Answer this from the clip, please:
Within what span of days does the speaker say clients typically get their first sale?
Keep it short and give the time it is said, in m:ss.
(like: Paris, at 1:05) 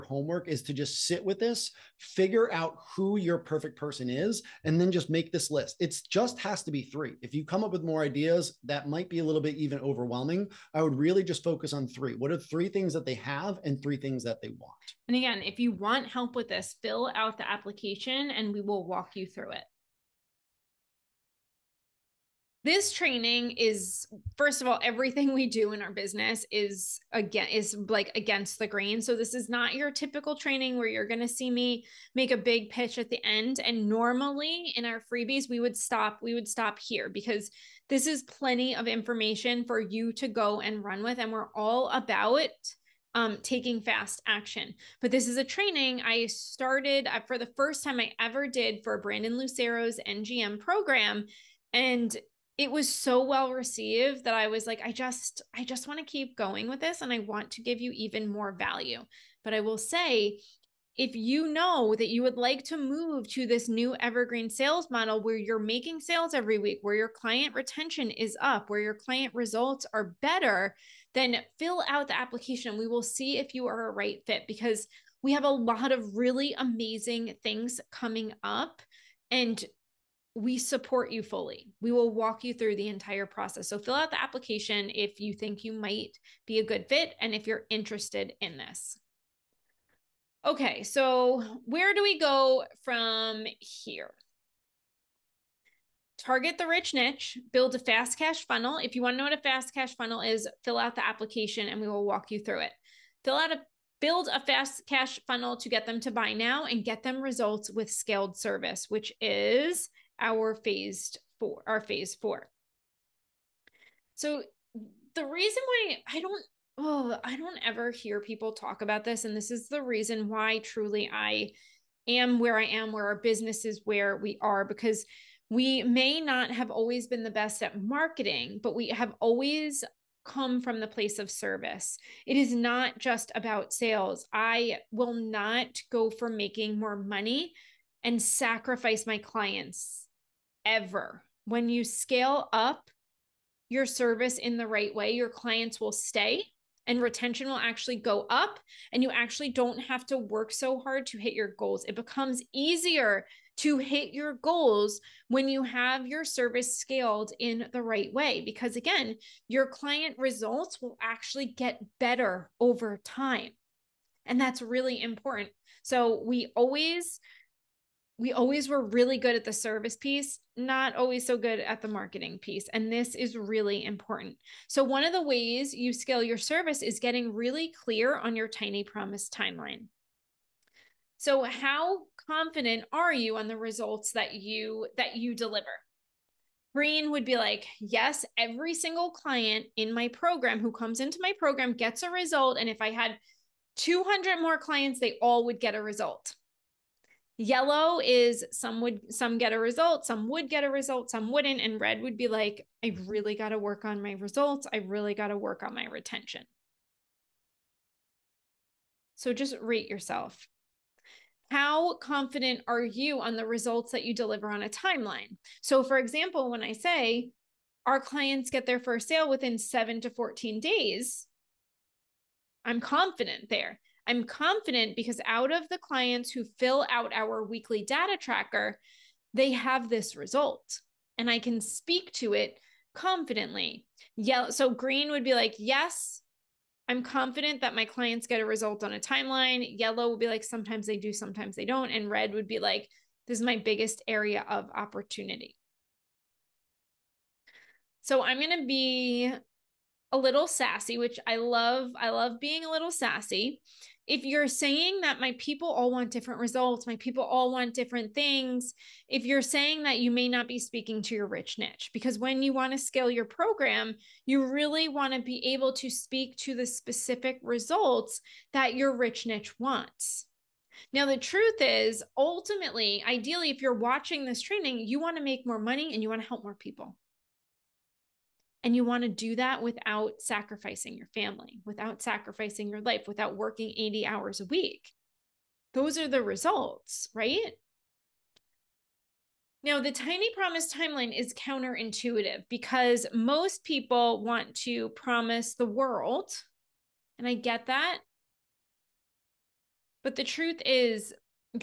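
7 to 14 days, at 3:39.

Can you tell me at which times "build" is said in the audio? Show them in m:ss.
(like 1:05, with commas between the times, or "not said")
1:37, 1:44.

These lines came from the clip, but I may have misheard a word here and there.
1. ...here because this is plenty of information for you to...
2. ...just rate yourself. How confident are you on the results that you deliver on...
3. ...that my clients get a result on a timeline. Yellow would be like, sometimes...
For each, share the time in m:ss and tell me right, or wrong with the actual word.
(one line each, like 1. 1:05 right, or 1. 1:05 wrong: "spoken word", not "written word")
1. 0:36 right
2. 3:29 right
3. 3:57 right.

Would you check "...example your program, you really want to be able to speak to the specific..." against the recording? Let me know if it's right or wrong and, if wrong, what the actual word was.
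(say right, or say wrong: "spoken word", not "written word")
wrong: "scale", not "example".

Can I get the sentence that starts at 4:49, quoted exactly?
Now, the tiny promise timeline is counterintuitive because most people want to promise the world.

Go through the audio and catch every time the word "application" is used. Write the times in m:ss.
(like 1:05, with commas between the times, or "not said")
0:17, 1:12, 1:24, 1:41.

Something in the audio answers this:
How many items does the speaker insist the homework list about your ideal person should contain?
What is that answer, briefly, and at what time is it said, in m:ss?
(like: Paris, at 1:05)
3, at 0:05.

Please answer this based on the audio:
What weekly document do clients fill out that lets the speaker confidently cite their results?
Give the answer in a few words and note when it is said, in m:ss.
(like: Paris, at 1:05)
weekly data tracker, at 3:47.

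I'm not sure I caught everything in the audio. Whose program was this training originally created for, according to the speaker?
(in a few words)
Brandon Lucero.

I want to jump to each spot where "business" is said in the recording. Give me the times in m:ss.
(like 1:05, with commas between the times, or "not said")
0:25, 2:03.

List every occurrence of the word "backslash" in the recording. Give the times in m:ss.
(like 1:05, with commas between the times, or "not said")
not said.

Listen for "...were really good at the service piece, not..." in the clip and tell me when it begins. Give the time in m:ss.
2:48.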